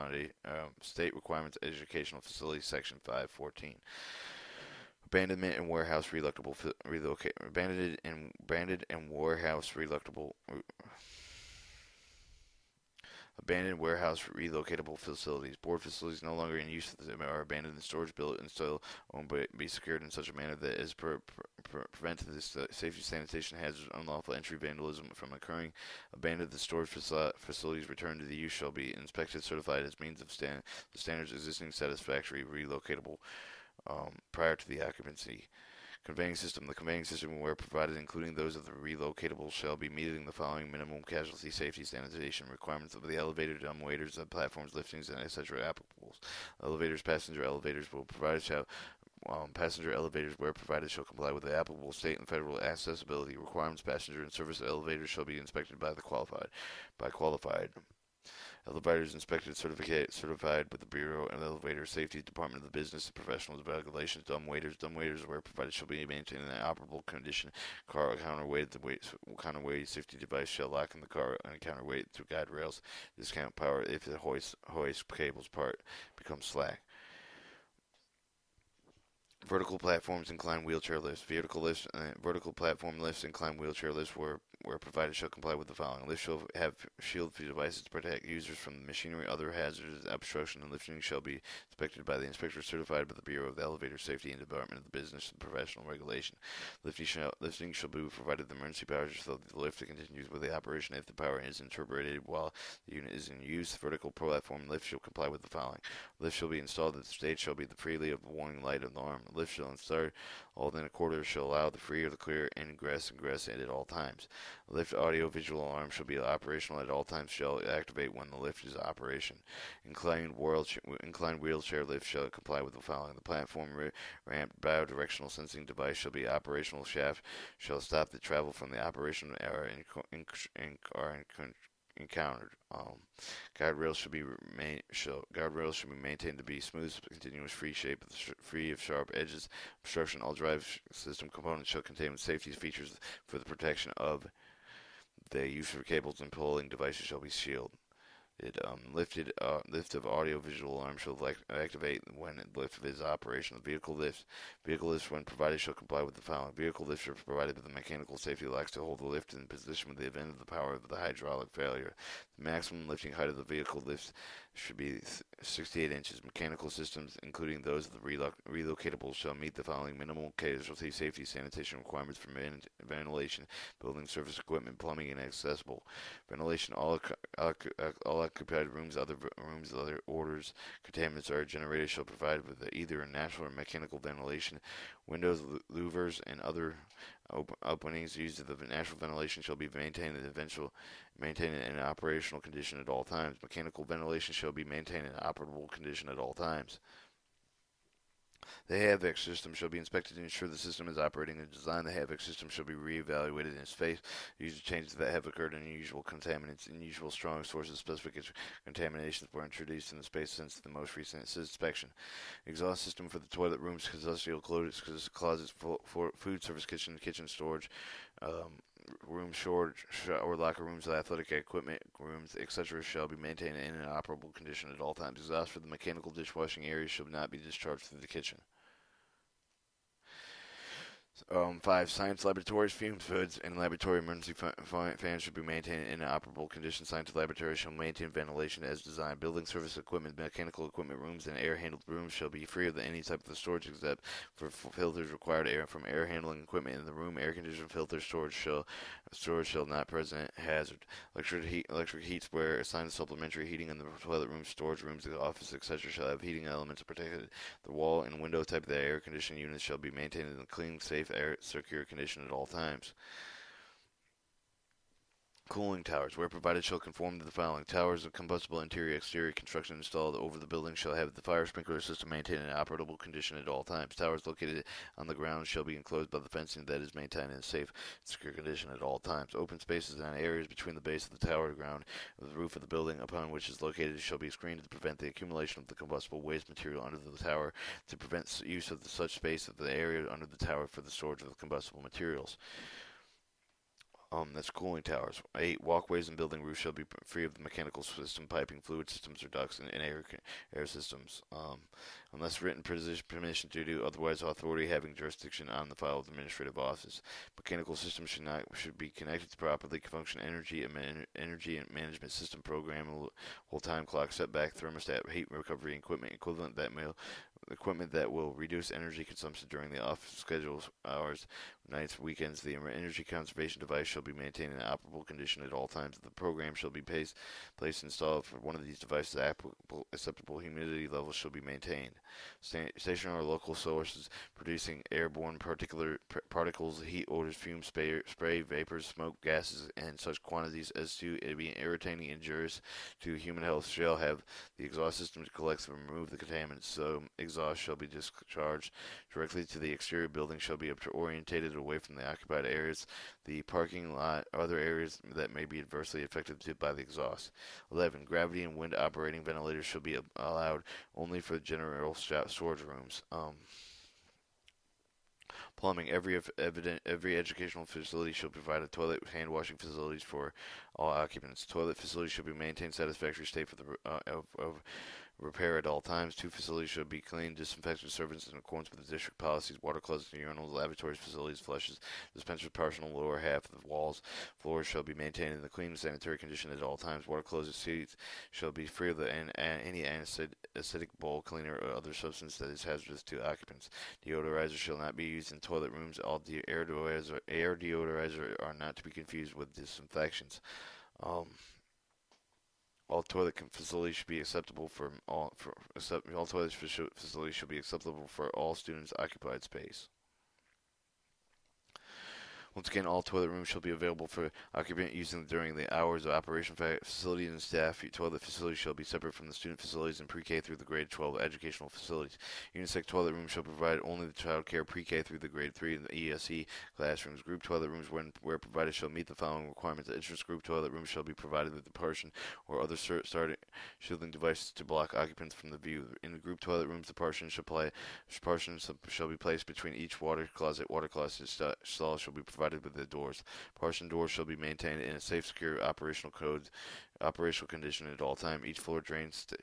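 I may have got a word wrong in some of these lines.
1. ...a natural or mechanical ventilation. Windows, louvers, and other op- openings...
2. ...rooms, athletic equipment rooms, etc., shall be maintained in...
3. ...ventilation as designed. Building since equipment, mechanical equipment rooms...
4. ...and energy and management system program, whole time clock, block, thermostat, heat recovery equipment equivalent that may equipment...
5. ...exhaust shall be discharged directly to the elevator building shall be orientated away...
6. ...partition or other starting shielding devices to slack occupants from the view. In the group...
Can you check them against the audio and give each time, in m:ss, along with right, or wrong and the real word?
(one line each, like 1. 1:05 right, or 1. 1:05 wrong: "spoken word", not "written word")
1. 3:03 right
2. 3:40 right
3. 3:58 wrong: "service", not "since"
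4. 5:10 wrong: "setback", not "block"
5. 5:47 wrong: "exterior", not "elevator"
6. 7:11 wrong: "block", not "slack".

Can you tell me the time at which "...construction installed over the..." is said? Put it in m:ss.
4:29.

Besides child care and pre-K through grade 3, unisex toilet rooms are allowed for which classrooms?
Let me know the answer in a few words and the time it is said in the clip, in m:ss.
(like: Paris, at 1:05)
ESE classrooms, at 7:06.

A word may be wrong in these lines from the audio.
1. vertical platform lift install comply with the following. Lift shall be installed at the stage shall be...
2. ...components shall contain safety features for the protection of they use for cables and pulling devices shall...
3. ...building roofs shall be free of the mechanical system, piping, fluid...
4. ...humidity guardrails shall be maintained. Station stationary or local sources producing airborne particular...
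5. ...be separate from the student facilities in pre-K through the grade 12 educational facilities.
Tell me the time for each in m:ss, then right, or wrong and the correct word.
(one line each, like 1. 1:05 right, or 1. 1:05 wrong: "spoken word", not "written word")
1. 1:43 wrong: "shall", not "install"
2. 2:21 right
3. 4:56 right
4. 5:30 wrong: "levels", not "guardrails"
5. 6:58 right.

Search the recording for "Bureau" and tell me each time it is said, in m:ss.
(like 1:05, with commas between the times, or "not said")
1:00, 1:33.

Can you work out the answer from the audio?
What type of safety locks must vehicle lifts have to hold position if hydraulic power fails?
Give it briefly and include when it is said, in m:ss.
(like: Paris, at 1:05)
mechanical safety locks, at 2:37.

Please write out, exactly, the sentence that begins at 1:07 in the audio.
Car counterweight, the weight, counterweight safety device shall lock in the car and counterweight through guide rails.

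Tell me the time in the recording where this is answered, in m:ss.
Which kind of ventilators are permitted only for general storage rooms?
5:58.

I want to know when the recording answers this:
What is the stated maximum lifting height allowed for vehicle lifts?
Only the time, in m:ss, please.
2:45.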